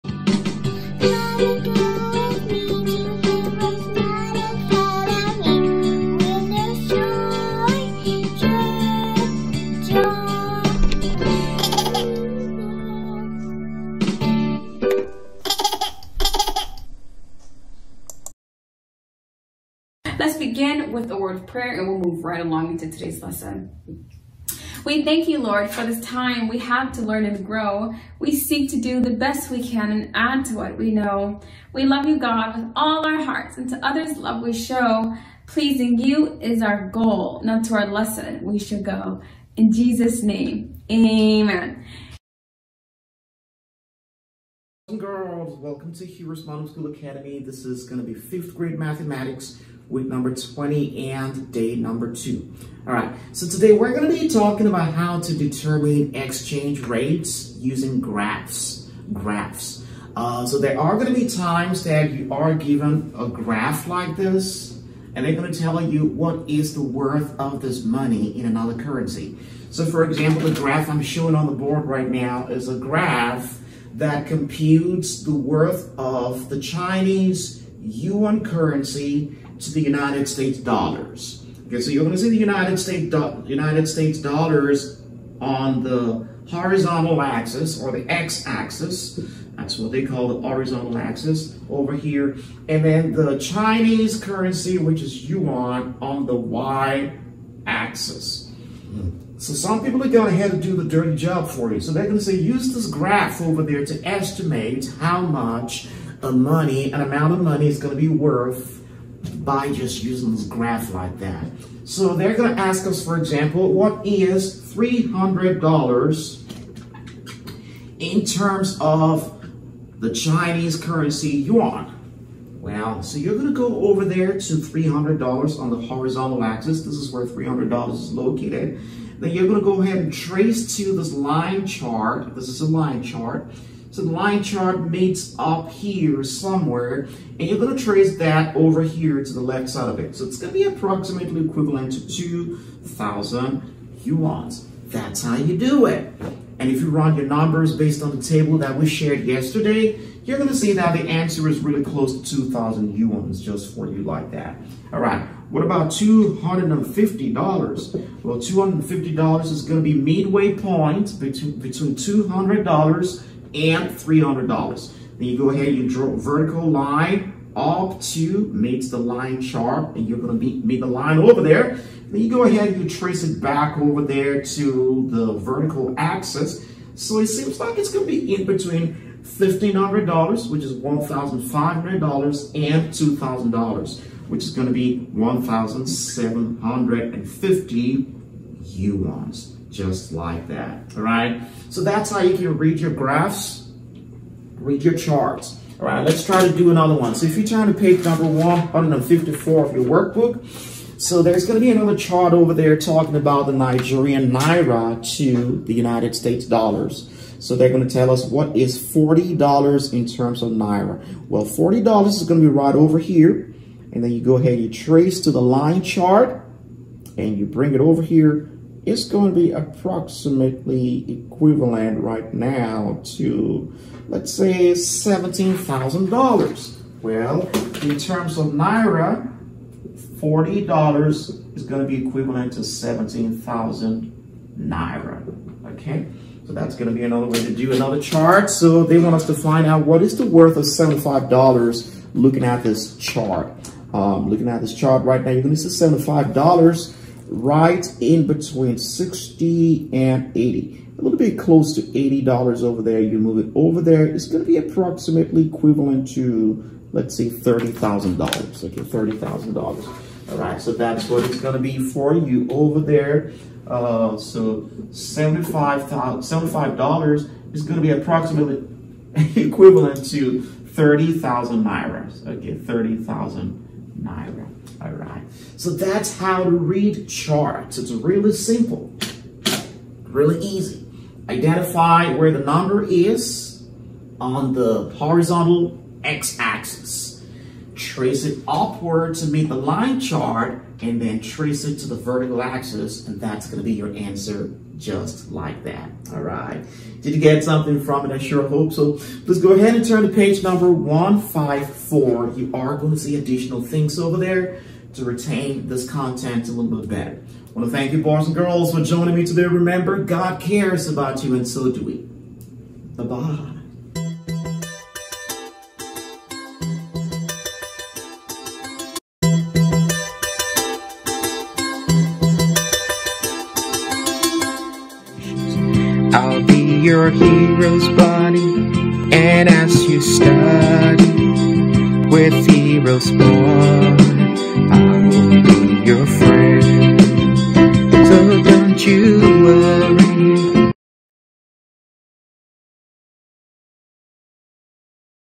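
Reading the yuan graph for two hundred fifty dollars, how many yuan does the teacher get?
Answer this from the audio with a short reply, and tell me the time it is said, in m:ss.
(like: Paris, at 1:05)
1,750, at 3:05.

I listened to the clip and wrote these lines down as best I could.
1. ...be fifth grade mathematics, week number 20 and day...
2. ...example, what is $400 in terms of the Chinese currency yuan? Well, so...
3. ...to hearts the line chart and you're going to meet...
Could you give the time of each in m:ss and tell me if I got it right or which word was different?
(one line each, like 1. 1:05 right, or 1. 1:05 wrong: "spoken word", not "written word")
1. 0:48 right
2. 1:53 wrong: "300", not "400"
3. 2:47 wrong: "meets", not "hearts".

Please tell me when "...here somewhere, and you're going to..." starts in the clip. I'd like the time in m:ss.
2:15.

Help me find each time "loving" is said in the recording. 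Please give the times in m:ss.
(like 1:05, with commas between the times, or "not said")
not said.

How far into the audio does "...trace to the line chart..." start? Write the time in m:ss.
3:34.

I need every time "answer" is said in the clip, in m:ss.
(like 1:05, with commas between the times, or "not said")
2:31, 4:53.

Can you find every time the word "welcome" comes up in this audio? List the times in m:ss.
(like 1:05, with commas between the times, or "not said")
0:45.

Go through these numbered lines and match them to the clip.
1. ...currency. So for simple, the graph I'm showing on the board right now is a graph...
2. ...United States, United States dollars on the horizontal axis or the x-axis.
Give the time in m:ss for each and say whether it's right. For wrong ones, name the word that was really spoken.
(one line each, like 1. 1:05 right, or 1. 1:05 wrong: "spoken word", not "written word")
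1. 1:08 wrong: "example", not "simple"
2. 1:22 right.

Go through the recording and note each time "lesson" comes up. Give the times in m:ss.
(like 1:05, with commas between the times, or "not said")
0:23, 0:37.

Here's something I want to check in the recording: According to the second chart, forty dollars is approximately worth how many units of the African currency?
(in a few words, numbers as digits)
17,000 naira.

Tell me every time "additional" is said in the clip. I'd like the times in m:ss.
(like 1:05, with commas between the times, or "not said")
5:03.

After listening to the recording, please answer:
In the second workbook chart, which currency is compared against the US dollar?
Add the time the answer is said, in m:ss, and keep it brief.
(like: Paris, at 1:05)
Nigerian Naira, at 3:23.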